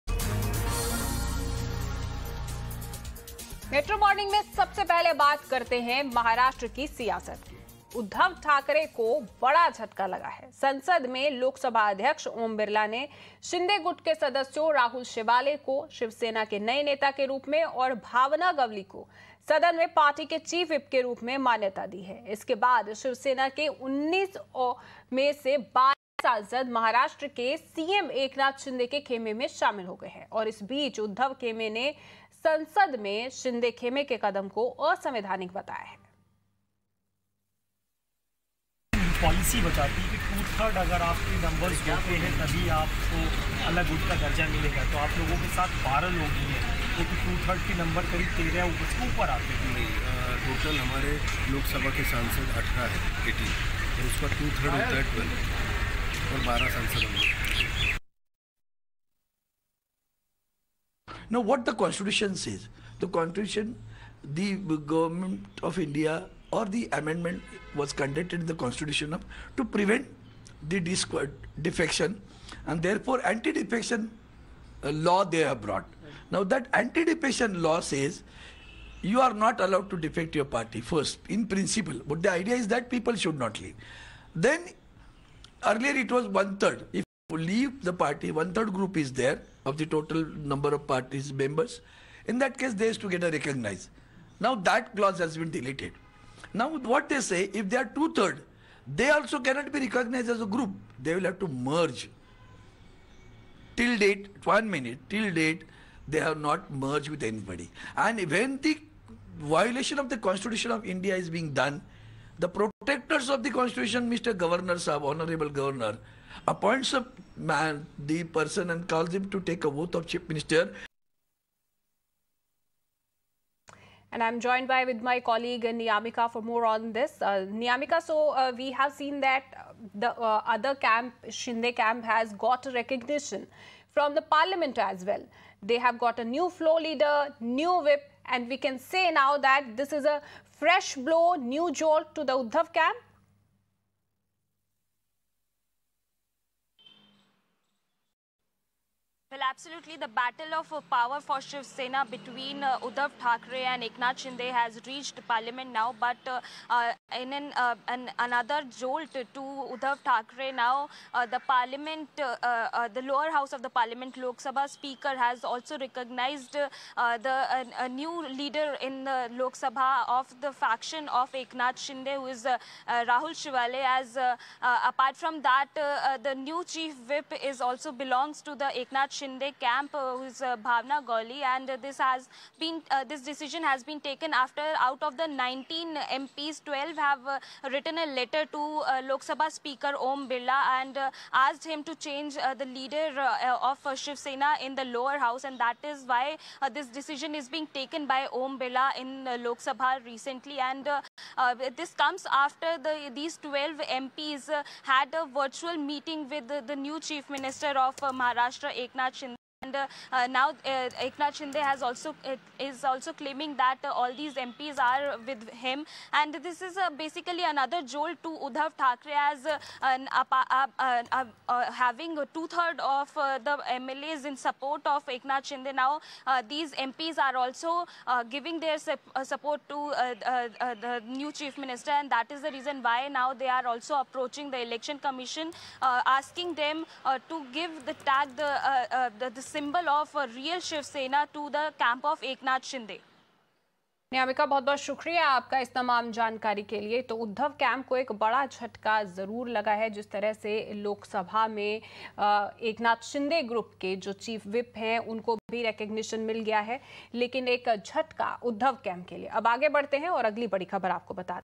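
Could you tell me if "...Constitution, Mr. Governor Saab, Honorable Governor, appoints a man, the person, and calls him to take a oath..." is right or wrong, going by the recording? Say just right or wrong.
right.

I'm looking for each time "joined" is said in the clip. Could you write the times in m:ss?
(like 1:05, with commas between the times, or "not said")
2:04.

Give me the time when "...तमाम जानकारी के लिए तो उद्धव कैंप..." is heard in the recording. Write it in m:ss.
4:05.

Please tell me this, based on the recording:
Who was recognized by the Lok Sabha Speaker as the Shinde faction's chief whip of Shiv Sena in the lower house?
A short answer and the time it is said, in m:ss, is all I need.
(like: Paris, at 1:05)
Bhavna Gawli, at 3:00.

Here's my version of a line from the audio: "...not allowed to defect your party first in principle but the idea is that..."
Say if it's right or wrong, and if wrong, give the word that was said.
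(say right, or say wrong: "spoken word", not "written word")
right.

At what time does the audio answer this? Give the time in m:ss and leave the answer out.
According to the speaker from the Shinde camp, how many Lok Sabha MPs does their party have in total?
0:52.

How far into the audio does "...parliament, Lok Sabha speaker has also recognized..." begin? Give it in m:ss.
2:43.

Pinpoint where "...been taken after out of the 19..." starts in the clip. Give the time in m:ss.
3:03.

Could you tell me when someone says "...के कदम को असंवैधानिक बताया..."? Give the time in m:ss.
0:34.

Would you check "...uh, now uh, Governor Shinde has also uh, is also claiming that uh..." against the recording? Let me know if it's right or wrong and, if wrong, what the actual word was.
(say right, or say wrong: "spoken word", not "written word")
wrong: "Eknath", not "Governor".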